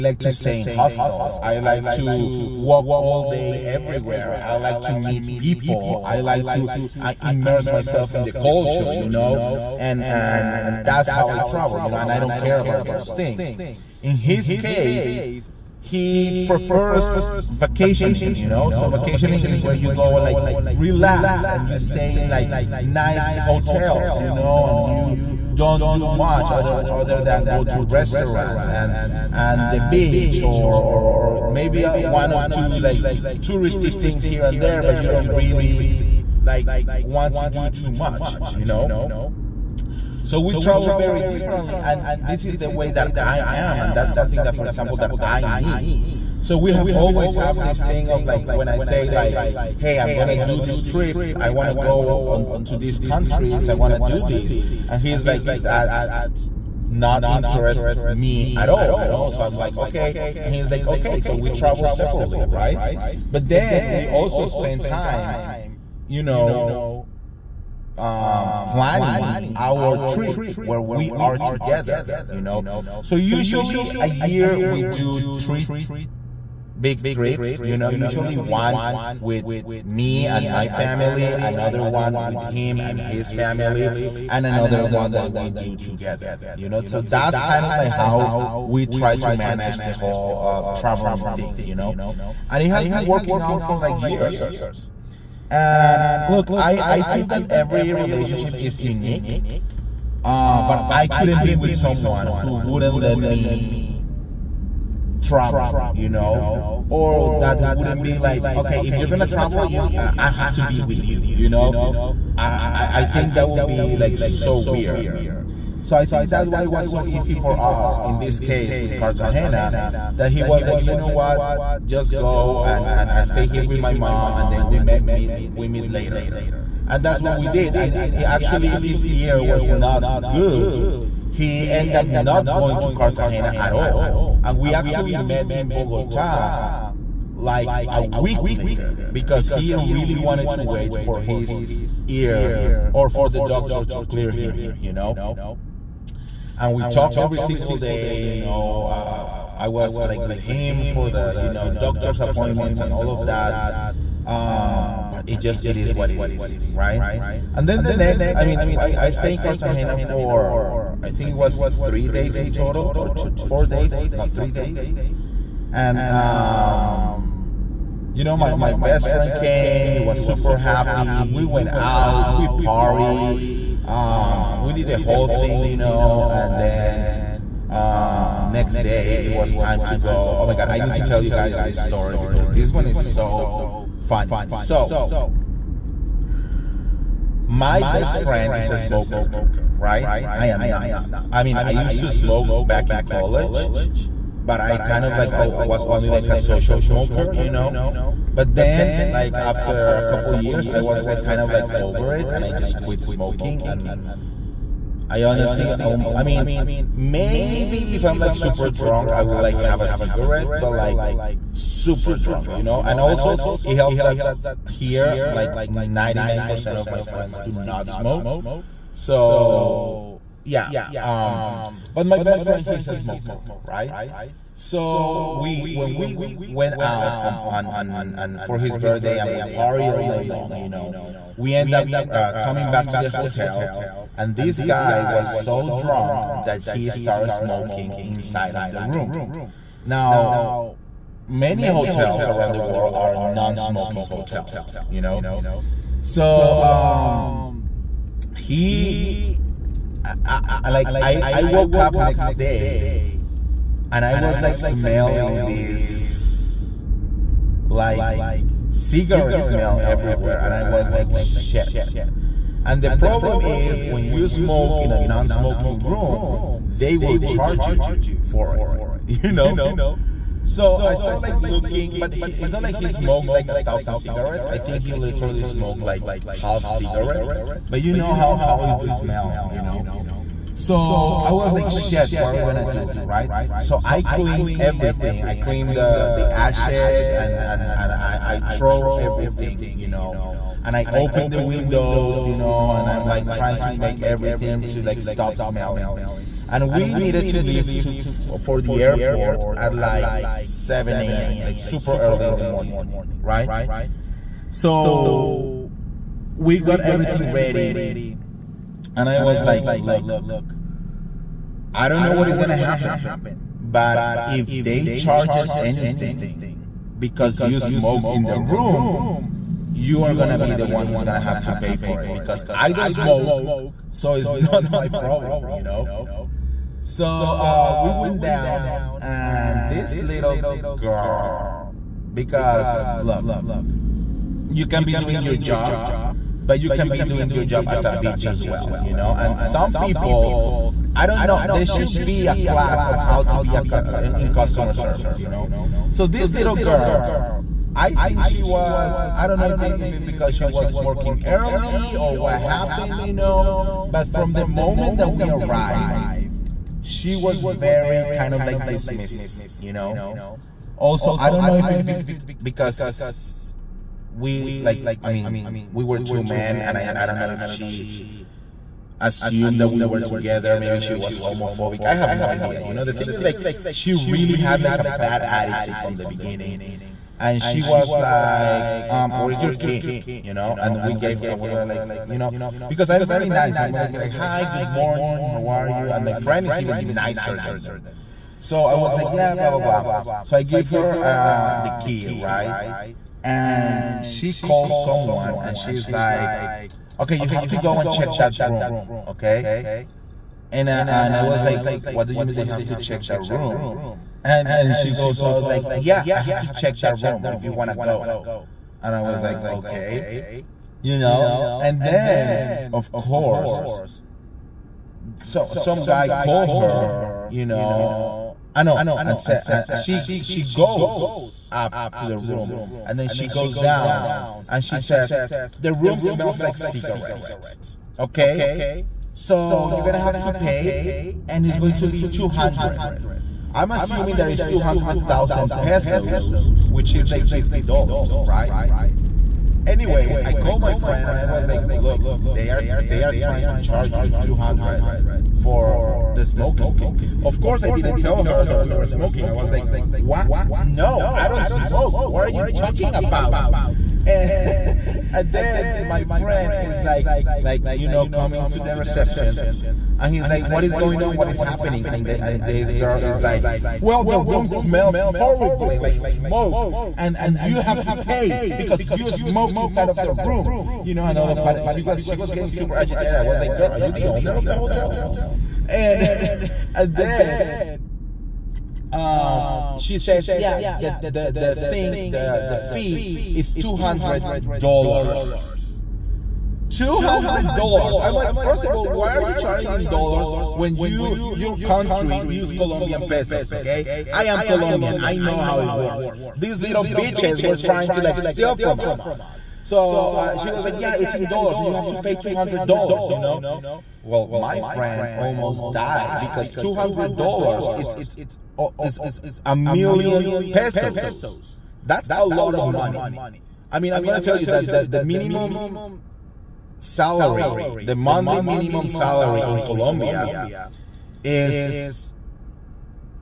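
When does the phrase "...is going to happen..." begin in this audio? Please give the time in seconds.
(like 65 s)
312 s.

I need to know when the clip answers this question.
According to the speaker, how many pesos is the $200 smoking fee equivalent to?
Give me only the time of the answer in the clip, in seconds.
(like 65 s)
509 s.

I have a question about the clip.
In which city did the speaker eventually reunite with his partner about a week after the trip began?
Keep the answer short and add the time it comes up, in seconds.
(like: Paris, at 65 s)
Bogota, at 135 s.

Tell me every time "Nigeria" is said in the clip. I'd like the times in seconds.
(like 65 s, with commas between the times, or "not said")
not said.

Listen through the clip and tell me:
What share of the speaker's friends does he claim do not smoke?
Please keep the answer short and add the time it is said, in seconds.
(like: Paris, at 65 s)
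99%, at 215 s.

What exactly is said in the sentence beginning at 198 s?
But then, like after a couple years, I was like kind of like over it, and I just quit smoking.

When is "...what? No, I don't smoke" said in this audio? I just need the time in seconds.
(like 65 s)
449 s.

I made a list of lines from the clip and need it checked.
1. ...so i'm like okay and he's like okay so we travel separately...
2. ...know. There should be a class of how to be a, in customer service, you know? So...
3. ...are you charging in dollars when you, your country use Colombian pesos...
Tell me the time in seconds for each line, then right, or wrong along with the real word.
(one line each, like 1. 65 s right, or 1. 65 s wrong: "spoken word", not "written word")
1. 59 s right
2. 341 s right
3. 489 s right.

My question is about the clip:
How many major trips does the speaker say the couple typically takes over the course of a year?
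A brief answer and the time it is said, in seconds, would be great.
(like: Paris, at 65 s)
3, at 75 s.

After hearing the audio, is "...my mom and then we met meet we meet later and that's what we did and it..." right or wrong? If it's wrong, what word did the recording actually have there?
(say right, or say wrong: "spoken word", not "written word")
right.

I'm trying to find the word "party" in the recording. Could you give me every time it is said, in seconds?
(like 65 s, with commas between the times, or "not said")
172 s, 229 s.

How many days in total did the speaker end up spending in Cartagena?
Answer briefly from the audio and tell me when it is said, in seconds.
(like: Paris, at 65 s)
4 days, at 163 s.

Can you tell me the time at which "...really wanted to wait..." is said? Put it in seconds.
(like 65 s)
139 s.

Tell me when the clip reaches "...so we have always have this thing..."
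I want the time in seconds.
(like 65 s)
46 s.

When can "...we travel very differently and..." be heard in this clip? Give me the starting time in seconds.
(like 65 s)
40 s.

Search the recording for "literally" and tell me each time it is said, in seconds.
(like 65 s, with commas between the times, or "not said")
274 s.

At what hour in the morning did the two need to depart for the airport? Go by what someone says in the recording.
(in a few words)
7 a.m.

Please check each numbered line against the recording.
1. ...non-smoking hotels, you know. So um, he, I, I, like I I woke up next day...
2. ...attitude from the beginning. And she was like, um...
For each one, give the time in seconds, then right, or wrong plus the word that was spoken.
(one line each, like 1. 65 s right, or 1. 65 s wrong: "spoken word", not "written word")
1. 243 s right
2. 375 s right.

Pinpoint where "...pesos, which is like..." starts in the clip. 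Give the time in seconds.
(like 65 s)
435 s.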